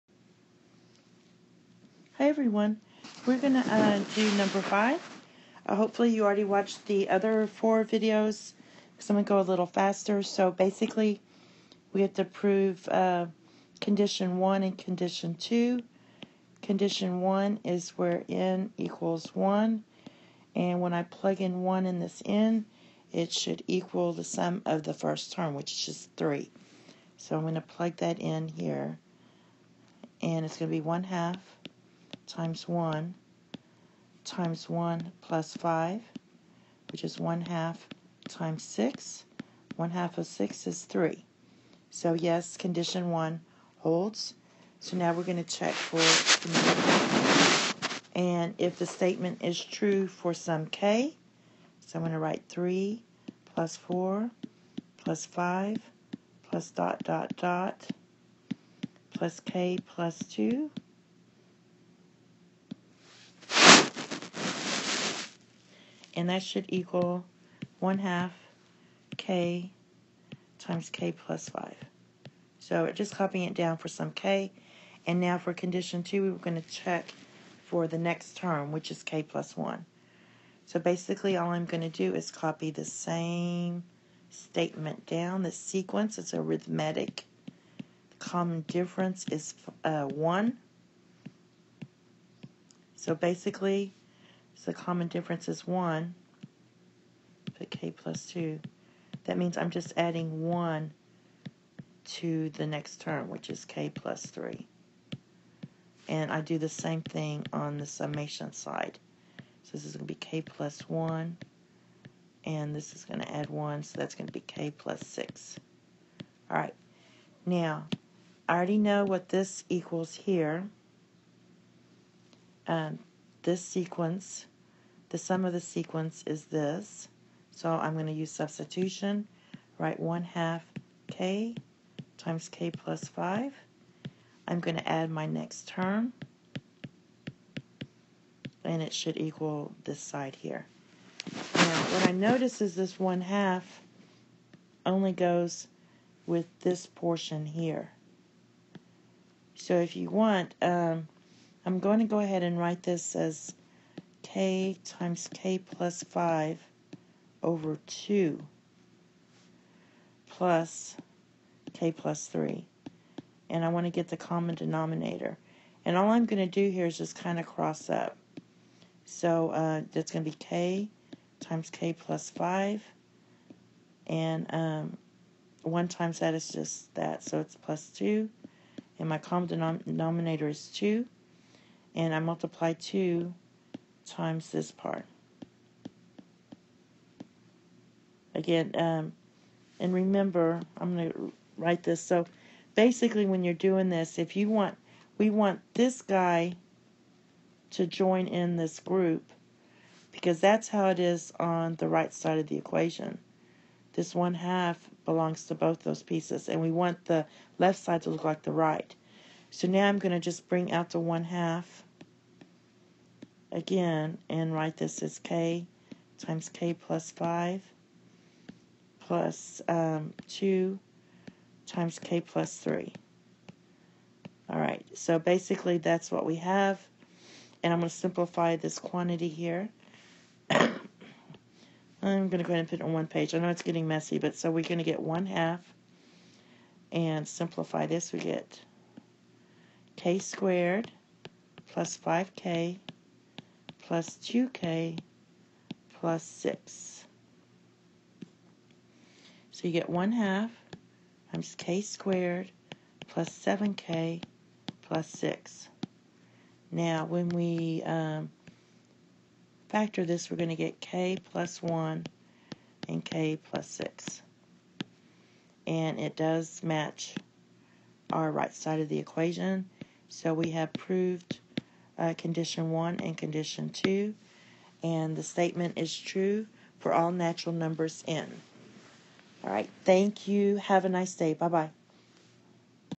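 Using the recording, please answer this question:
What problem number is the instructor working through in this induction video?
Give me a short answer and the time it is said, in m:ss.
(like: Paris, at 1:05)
5, at 0:04.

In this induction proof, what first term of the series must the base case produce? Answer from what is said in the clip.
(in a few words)
3.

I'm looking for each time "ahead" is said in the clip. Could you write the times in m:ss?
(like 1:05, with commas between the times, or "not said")
2:32, 3:52.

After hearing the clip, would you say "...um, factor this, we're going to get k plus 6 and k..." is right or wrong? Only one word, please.
wrong.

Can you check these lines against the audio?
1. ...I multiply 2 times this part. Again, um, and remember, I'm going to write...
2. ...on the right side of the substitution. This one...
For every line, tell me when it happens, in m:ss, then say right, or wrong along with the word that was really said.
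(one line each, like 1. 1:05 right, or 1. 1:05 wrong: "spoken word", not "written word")
1. 3:02 right
2. 3:21 wrong: "equation", not "substitution".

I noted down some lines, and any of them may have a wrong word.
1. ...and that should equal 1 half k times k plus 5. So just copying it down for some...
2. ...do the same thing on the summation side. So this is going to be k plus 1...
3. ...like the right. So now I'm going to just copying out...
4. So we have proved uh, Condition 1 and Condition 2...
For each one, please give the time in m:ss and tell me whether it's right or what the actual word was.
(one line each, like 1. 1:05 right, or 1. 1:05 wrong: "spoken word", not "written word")
1. 1:06 right
2. 1:46 right
3. 3:28 wrong: "bring", not "copying"
4. 4:30 right.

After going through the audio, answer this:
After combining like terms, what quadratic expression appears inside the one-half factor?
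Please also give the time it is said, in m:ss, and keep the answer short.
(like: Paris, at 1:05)
k squared plus 7k plus 6, at 4:11.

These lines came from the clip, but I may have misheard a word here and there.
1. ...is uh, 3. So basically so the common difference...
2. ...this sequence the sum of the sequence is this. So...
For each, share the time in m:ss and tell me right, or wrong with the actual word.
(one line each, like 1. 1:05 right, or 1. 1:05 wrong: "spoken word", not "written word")
1. 1:29 wrong: "1", not "3"
2. 2:03 right.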